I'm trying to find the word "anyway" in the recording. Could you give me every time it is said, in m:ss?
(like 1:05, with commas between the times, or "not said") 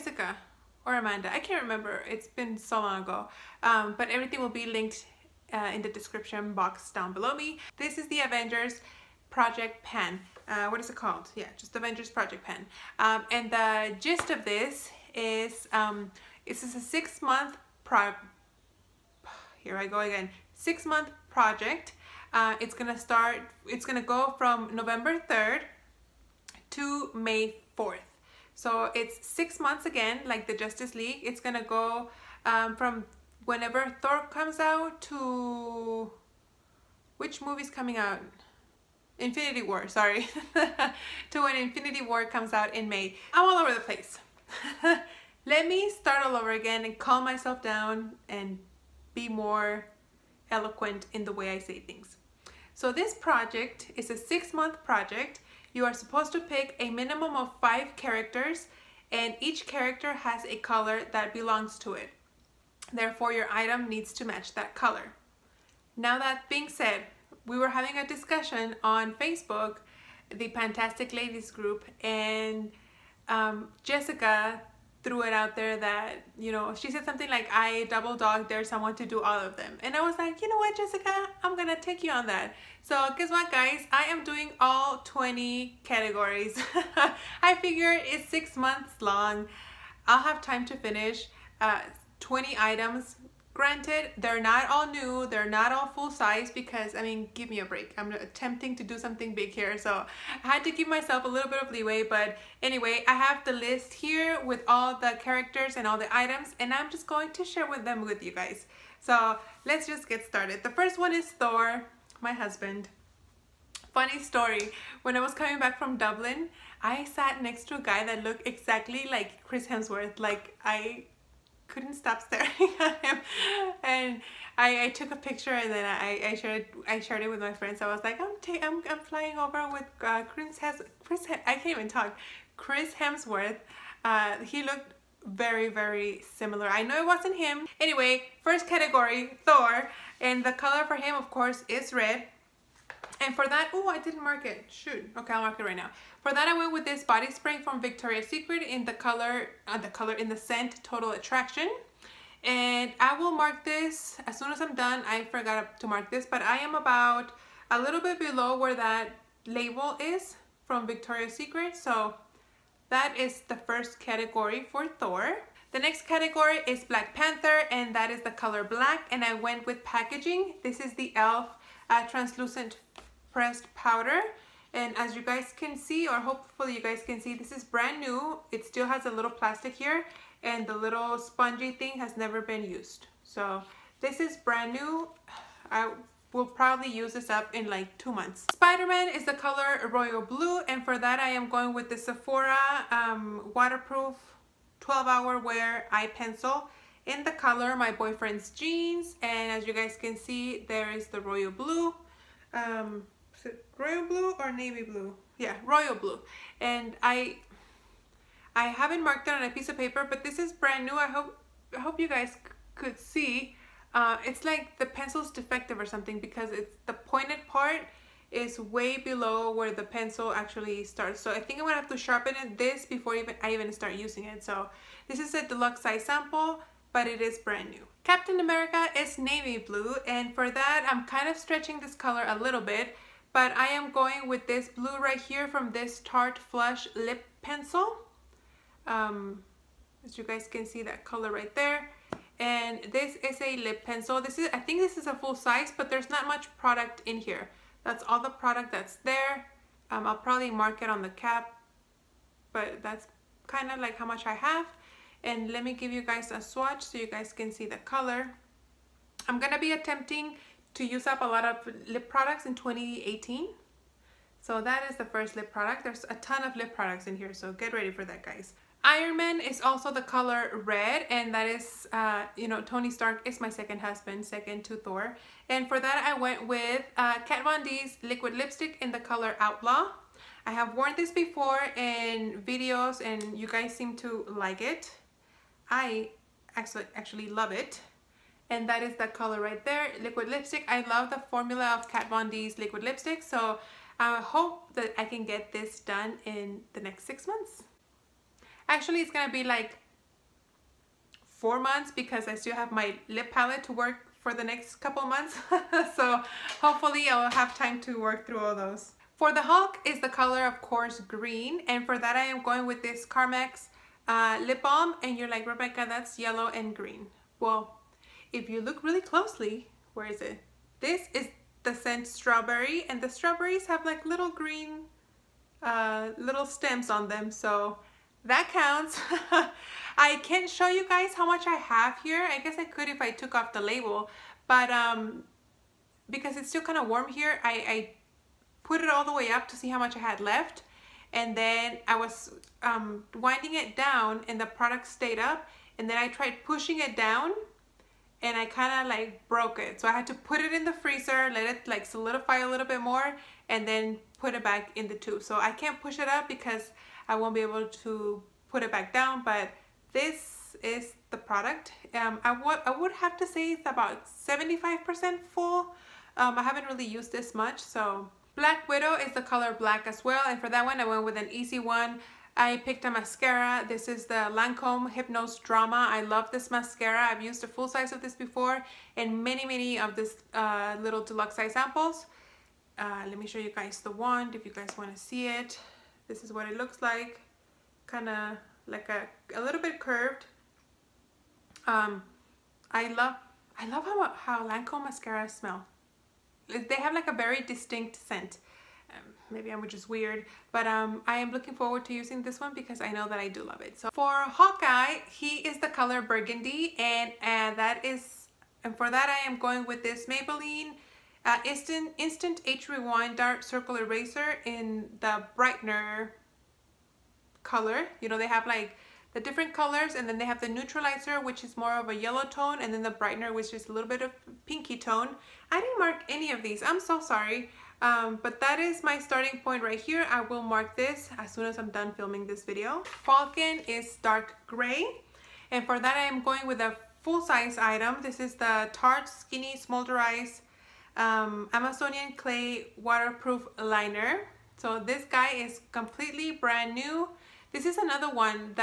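1:42, 2:17.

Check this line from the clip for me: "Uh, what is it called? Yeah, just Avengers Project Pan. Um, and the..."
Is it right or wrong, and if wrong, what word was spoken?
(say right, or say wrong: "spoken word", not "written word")
right.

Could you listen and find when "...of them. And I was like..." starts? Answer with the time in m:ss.
1:19.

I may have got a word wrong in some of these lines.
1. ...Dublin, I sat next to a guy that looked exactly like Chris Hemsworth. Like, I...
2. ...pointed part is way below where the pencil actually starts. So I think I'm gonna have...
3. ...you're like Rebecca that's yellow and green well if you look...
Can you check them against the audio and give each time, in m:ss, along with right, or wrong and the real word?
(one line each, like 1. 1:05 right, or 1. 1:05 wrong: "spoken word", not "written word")
1. 1:55 right
2. 3:36 right
3. 5:15 right.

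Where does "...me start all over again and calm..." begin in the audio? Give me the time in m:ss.
0:45.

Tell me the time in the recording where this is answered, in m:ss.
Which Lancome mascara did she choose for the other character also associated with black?
6:14.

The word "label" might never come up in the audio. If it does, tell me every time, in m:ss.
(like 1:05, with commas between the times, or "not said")
2:39, 5:33.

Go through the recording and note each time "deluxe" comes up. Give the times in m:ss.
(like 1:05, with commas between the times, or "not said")
3:45, 6:21.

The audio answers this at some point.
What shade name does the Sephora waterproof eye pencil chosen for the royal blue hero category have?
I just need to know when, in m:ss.
3:17.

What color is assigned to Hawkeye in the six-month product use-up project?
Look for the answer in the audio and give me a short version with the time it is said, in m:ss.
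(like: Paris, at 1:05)
Burgundy, at 6:46.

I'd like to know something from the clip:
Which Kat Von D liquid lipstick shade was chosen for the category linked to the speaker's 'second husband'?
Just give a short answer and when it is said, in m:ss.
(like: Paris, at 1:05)
Outlaw, at 4:39.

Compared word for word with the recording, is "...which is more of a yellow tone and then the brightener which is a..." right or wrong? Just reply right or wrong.
right.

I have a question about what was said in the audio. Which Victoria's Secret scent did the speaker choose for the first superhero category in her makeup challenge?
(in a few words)
Total Attraction.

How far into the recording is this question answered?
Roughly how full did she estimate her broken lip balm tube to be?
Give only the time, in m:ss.
6:04.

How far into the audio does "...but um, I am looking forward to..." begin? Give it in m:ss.
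6:40.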